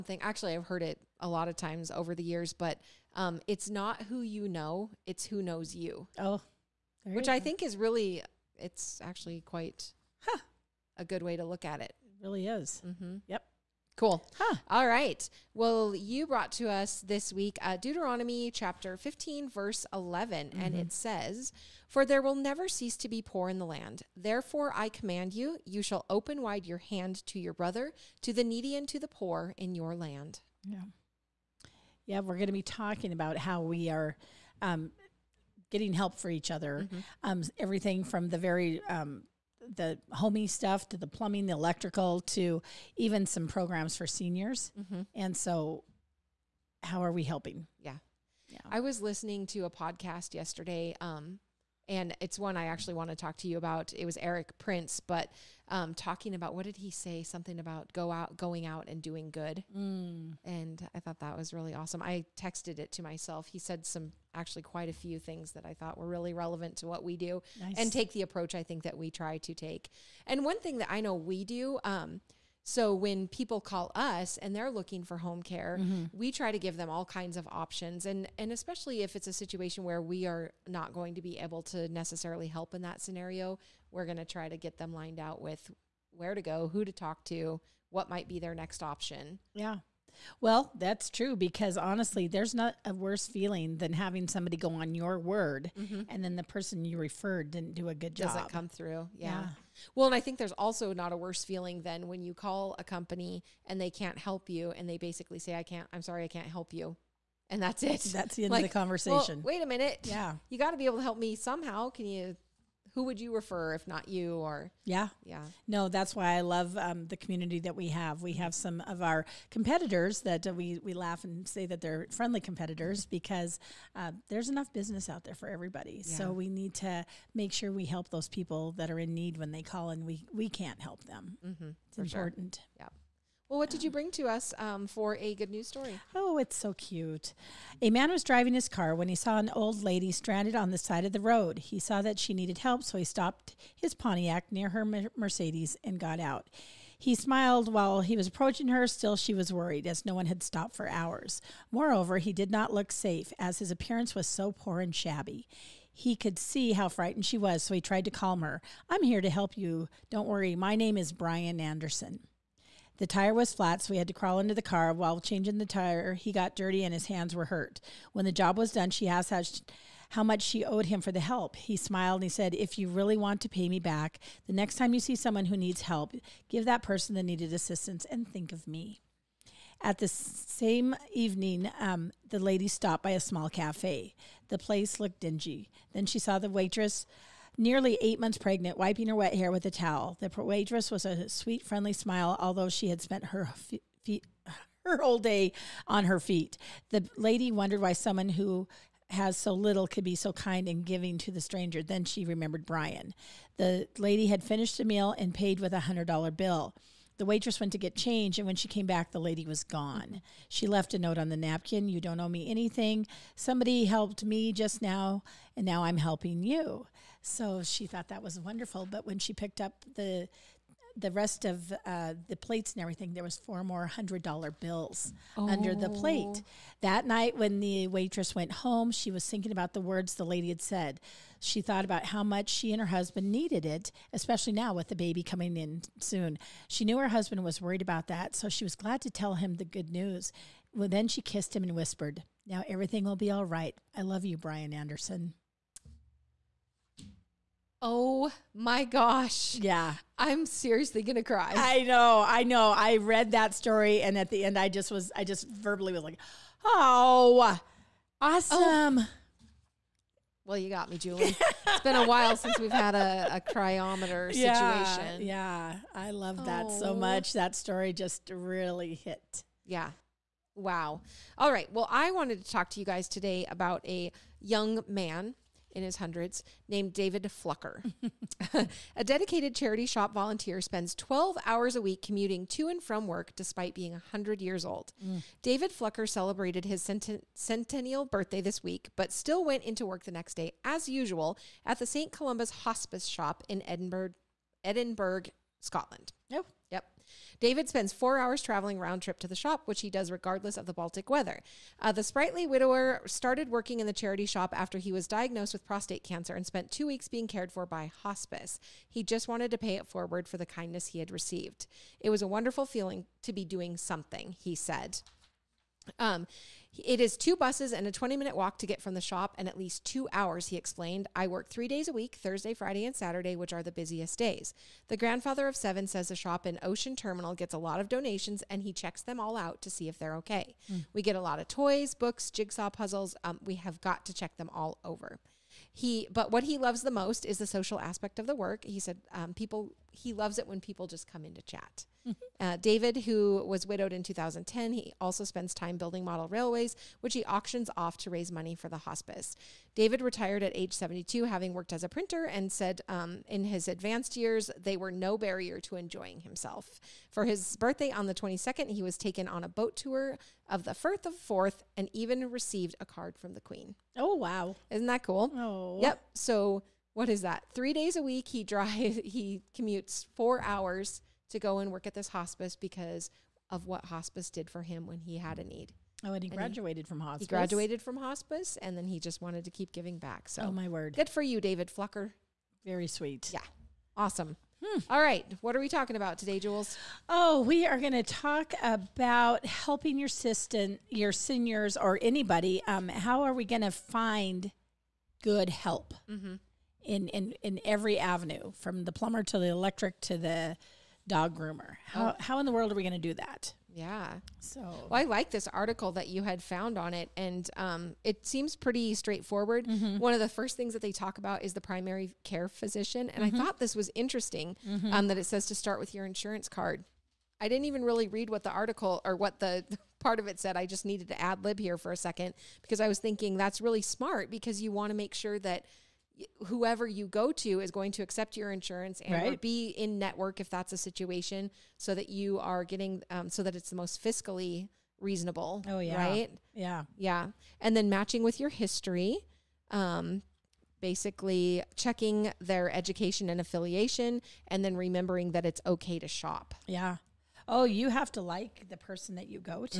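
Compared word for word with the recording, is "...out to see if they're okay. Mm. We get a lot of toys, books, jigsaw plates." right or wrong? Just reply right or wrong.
wrong.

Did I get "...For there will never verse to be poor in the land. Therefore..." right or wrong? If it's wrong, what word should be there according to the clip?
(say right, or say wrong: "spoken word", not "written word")
wrong: "cease", not "verse".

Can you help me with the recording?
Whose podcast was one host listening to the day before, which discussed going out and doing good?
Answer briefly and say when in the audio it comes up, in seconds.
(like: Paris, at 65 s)
Eric Prince, at 54 s.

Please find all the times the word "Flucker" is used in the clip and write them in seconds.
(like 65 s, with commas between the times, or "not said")
277 s, 285 s, 381 s.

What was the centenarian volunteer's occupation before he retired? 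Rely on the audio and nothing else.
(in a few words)
printer.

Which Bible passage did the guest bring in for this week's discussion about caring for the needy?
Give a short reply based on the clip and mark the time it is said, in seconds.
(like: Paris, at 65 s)
Deuteronomy 15:11, at 17 s.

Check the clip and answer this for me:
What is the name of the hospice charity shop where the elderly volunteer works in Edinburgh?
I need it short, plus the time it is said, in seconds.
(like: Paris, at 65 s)
St. Columba's Hospice Shop, at 291 s.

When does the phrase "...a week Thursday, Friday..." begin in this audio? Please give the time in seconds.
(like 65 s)
321 s.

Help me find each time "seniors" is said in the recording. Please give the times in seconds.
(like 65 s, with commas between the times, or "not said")
44 s, 391 s.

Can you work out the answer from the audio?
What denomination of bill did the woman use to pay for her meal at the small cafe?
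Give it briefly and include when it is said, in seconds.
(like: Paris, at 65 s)
100 dollars, at 205 s.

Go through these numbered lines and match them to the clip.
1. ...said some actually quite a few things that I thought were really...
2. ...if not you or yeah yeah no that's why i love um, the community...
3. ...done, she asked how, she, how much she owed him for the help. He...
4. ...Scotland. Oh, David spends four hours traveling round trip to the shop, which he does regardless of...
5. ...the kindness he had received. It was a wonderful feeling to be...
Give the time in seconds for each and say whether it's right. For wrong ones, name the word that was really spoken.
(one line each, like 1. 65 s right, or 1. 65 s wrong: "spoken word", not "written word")
1. 63 s right
2. 113 s right
3. 168 s right
4. 295 s right
5. 310 s right.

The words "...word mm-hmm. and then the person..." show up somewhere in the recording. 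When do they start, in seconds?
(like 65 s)
95 s.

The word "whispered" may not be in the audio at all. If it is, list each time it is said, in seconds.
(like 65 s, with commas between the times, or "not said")
241 s.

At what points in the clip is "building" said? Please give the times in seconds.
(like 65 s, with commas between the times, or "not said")
345 s.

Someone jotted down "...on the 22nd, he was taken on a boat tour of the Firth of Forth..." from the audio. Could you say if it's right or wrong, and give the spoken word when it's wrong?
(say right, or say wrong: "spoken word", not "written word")
right.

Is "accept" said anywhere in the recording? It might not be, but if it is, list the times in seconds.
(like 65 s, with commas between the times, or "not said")
428 s.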